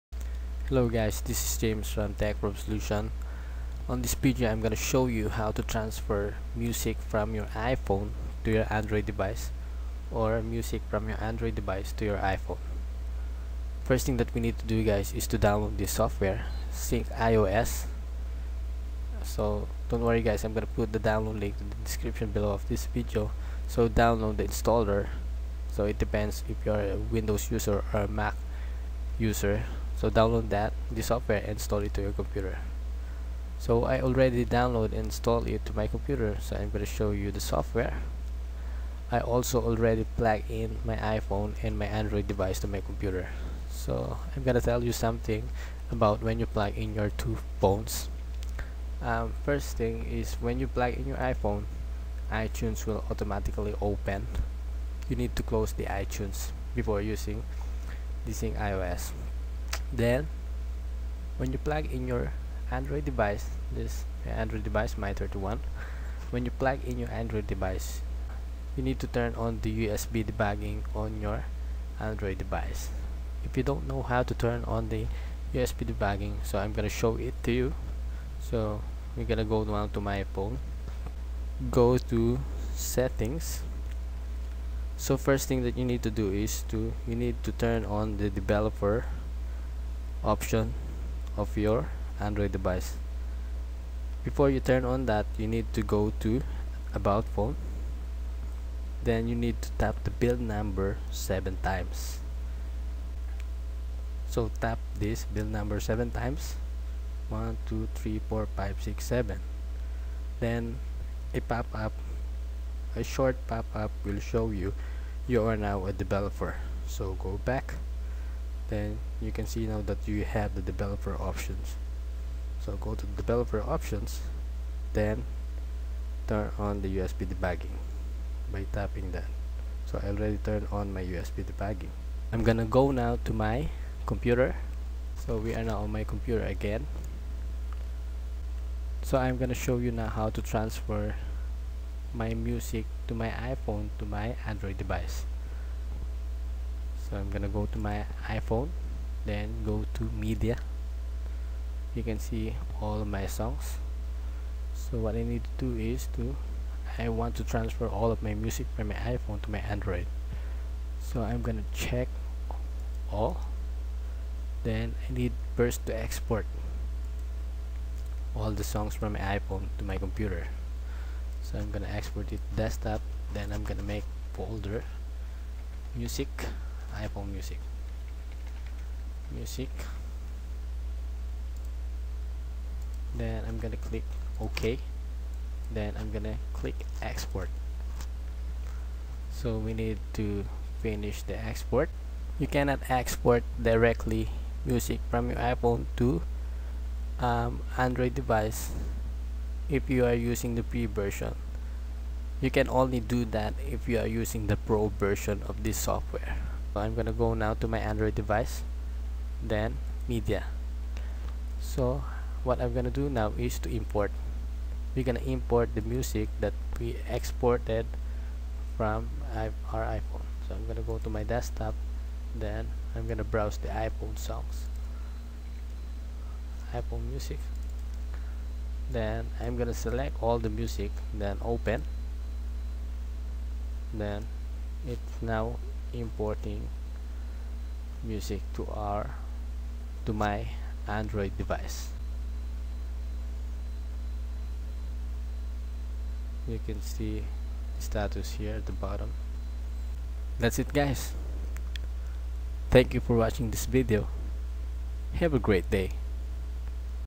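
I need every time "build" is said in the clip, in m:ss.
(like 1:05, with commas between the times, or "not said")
1:40, 1:45.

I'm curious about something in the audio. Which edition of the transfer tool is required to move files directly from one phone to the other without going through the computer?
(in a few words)
pro version.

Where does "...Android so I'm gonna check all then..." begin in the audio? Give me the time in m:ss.
2:39.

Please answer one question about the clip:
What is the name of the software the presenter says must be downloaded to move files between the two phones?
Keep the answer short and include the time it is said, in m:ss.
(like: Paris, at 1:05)
Syncios, at 0:16.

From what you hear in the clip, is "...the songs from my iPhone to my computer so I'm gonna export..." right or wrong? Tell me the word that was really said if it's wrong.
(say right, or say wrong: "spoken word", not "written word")
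right.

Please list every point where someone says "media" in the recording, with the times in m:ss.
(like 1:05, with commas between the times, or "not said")
2:30, 3:30.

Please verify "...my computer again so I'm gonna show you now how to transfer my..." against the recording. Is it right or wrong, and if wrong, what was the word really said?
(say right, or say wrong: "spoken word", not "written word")
right.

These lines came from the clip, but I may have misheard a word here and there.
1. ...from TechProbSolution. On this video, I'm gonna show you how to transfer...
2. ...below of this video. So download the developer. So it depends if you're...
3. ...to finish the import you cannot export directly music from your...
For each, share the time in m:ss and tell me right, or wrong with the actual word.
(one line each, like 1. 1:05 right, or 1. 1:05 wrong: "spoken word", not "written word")
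1. 0:01 right
2. 0:22 wrong: "installer", not "developer"
3. 3:10 wrong: "export", not "import".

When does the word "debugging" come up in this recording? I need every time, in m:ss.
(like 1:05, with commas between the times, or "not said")
1:10, 1:15, 2:07, 2:11.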